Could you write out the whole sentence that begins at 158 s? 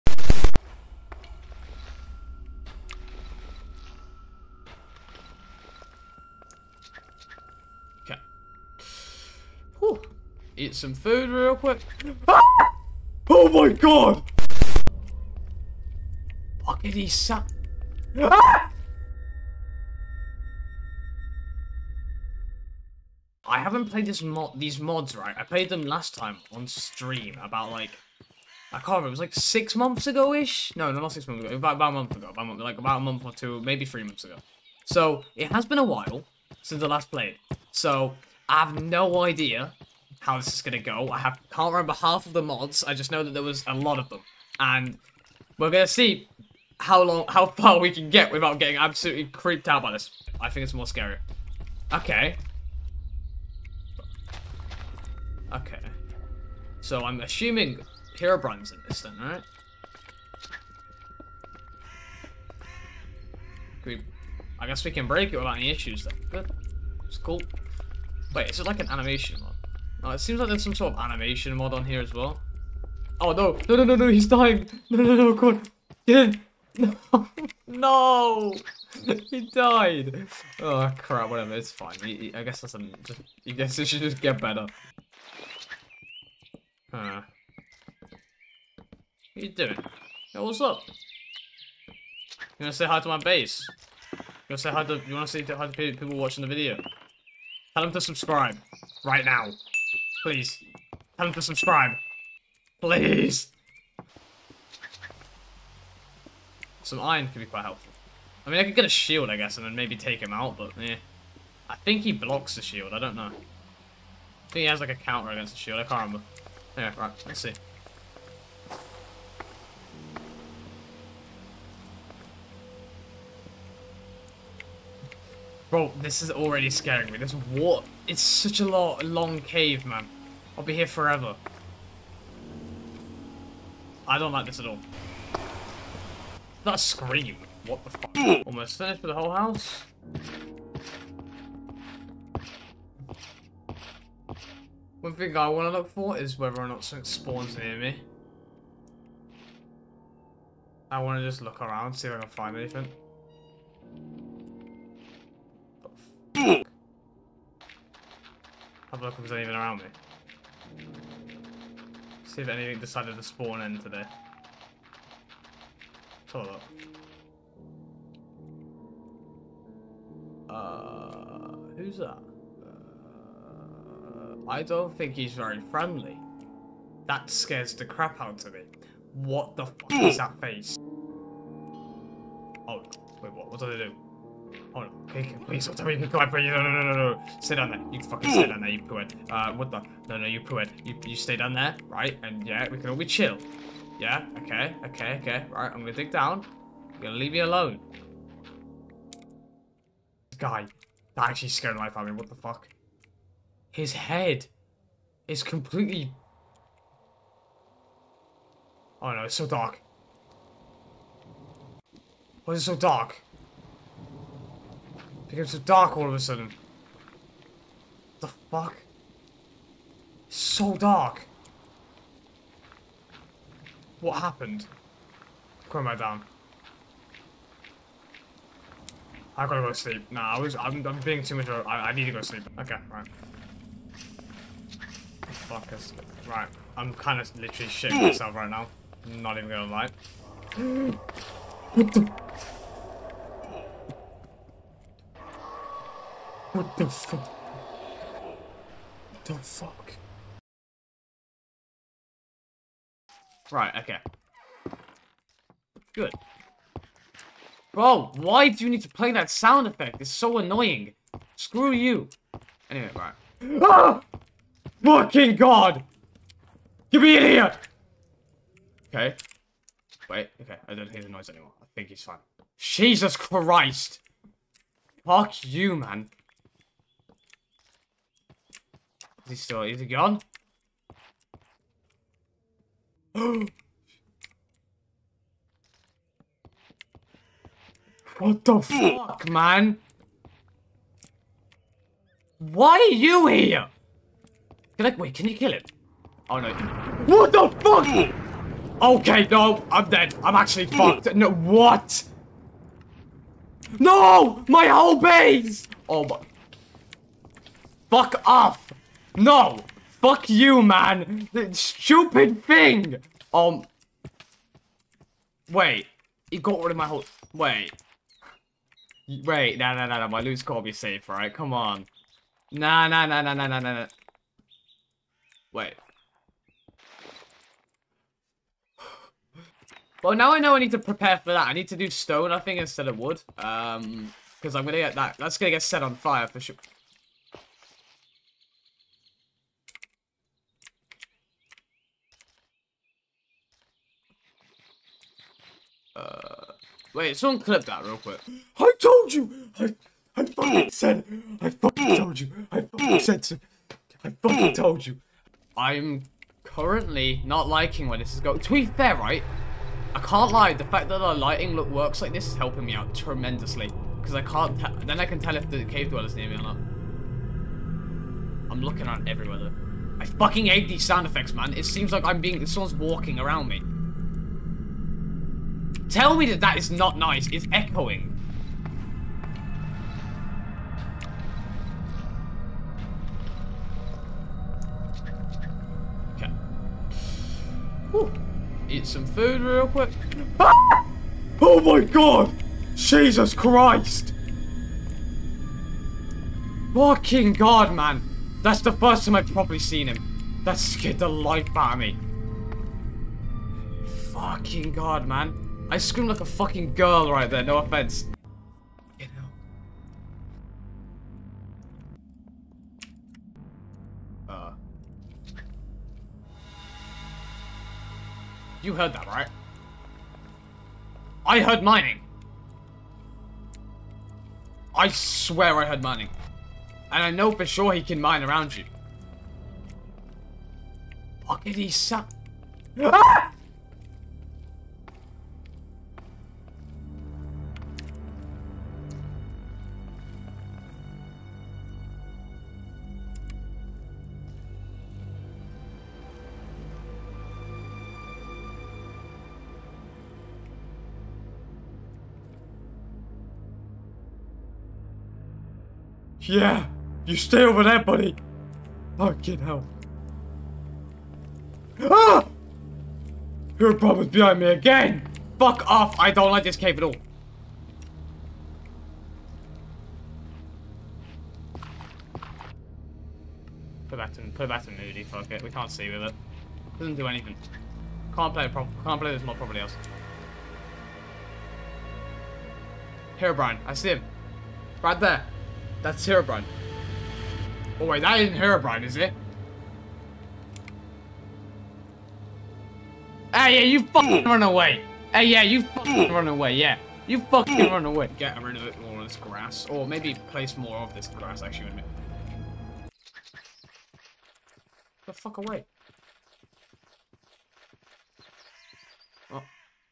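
Have a look if there's anything around me.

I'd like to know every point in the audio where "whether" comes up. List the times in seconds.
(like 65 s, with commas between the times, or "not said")
146 s.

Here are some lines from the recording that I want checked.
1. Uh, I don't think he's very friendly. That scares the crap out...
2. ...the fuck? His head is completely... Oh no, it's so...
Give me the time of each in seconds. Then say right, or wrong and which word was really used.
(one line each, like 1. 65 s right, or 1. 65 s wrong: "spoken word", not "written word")
1. 172 s right
2. 202 s right.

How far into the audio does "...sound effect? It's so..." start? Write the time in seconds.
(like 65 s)
259 s.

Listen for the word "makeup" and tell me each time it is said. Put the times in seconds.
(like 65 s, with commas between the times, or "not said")
not said.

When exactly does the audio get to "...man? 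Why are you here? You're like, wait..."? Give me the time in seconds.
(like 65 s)
289 s.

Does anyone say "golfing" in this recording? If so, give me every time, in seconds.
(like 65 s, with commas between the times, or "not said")
not said.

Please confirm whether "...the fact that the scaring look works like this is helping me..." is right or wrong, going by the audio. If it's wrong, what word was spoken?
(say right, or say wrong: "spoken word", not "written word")
wrong: "lighting", not "scaring".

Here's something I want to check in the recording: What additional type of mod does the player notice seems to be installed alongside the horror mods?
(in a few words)
Animation mod.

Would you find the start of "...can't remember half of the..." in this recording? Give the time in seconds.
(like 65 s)
41 s.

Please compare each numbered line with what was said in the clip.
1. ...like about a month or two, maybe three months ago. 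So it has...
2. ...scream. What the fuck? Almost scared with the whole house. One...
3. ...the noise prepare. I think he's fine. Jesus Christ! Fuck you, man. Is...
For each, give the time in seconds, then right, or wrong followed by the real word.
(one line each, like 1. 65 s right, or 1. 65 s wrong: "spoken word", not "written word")
1. 32 s right
2. 136 s wrong: "finished", not "scared"
3. 271 s wrong: "anymore", not "prepare".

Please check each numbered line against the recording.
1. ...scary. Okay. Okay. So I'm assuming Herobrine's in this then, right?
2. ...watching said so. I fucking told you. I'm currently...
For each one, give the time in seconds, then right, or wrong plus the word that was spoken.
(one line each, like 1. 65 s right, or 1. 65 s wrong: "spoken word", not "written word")
1. 50 s right
2. 352 s wrong: "fucking", not "watching".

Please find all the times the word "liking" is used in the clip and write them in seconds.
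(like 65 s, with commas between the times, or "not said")
357 s.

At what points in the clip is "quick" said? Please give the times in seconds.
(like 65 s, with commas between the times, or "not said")
11 s, 347 s, 389 s.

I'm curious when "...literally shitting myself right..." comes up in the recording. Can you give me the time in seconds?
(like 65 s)
237 s.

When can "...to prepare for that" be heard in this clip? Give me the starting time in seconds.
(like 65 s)
330 s.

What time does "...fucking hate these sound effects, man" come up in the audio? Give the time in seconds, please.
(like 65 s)
370 s.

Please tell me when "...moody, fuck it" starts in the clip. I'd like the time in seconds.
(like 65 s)
474 s.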